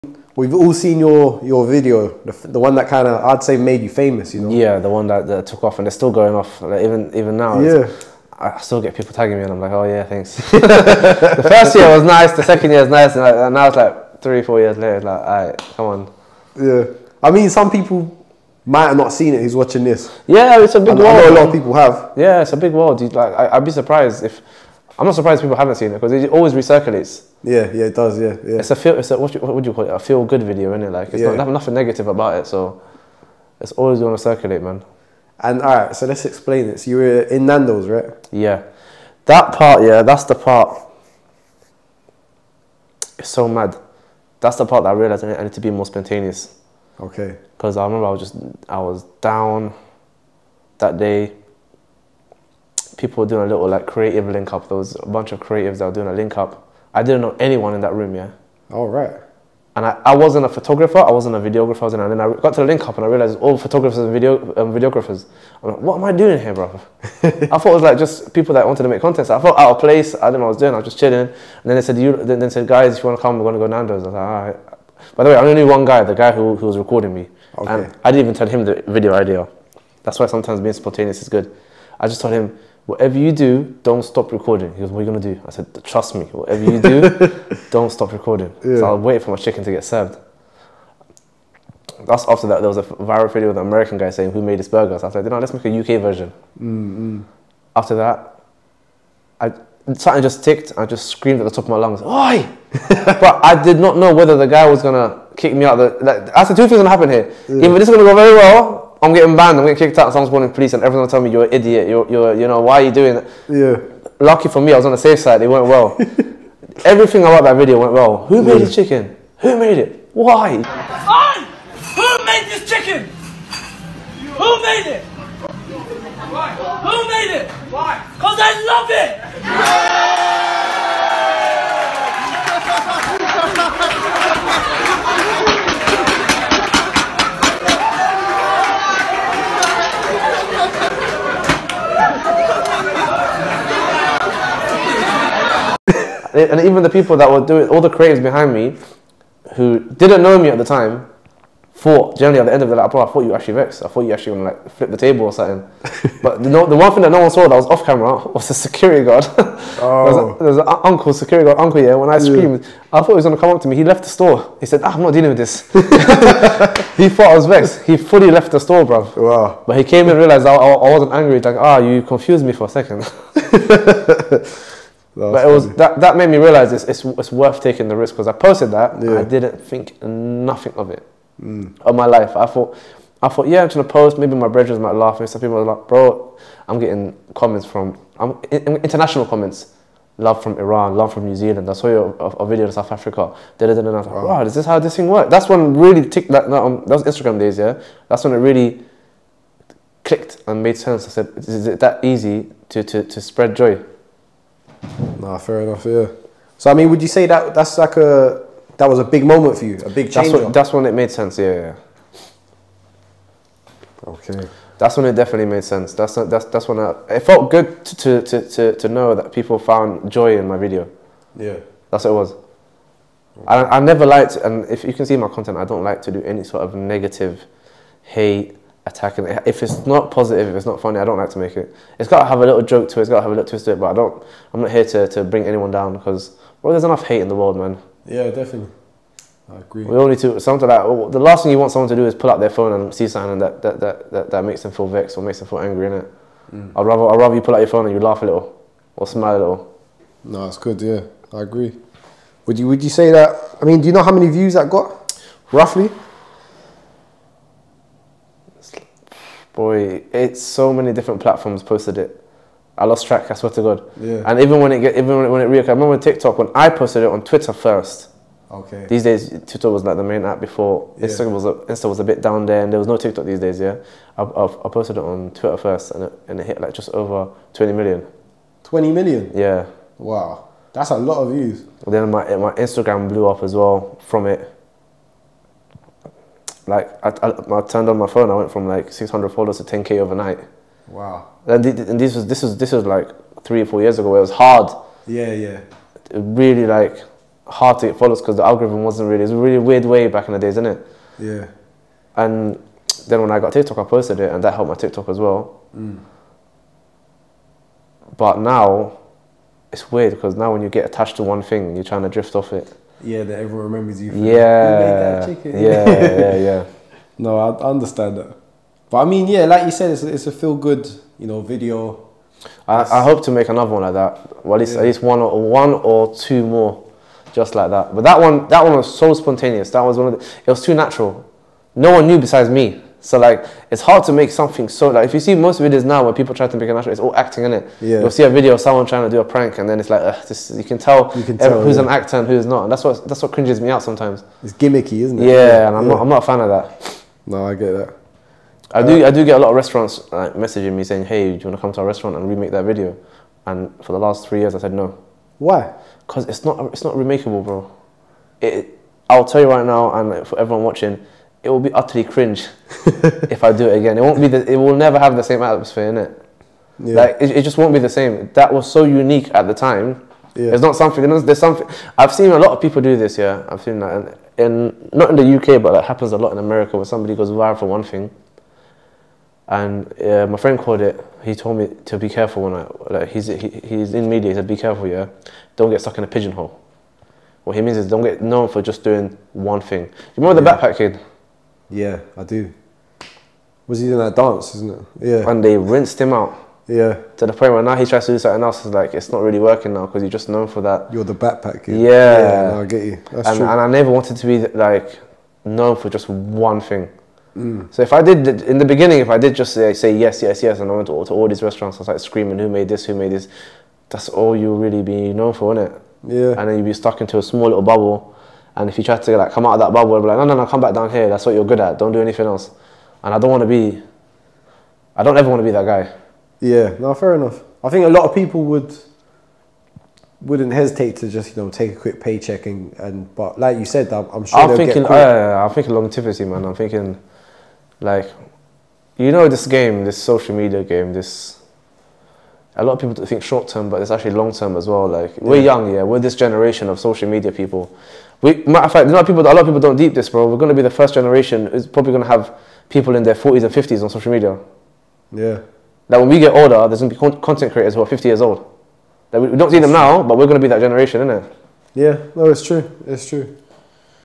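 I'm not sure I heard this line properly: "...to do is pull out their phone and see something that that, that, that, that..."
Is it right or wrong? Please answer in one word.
right.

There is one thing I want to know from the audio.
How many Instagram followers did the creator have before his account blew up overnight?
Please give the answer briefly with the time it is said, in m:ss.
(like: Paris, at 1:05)
600, at 4:48.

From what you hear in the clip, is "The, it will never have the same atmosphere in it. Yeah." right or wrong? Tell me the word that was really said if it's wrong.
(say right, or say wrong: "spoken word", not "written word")
right.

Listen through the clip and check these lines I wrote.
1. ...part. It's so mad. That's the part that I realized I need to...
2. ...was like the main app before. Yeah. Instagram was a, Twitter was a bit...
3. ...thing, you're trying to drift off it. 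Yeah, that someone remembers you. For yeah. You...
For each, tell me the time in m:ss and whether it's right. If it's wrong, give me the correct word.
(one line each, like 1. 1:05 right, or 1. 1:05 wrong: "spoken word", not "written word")
1. 0:40 right
2. 4:29 wrong: "Insta", not "Twitter"
3. 5:11 wrong: "everyone", not "someone".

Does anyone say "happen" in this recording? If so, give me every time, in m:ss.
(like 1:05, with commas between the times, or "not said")
1:46, 6:15.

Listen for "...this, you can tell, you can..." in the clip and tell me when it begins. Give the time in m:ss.
5:40.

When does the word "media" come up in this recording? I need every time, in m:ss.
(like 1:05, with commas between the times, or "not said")
6:24, 7:20, 7:27, 7:34.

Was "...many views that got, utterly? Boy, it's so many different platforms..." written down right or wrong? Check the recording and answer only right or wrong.
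wrong.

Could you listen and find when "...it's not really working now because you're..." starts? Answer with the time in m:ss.
6:38.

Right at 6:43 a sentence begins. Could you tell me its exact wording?
and I never wanted to be like known for just one thing.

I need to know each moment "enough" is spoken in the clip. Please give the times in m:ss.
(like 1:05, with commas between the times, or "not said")
3:25, 3:56, 7:07.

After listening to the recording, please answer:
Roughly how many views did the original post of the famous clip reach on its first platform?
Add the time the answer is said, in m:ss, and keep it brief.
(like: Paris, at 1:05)
Just over 20 million, at 4:36.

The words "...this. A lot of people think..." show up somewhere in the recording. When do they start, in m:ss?
7:20.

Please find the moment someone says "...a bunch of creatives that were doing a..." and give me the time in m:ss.
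0:55.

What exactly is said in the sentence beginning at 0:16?
Yeah, I mean, some people might have not seen it who's watching this.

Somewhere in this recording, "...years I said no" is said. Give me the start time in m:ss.
5:54.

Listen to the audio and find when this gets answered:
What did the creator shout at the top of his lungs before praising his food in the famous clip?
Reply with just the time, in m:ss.
1:42.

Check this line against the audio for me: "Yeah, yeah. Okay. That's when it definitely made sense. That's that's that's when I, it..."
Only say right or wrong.
right.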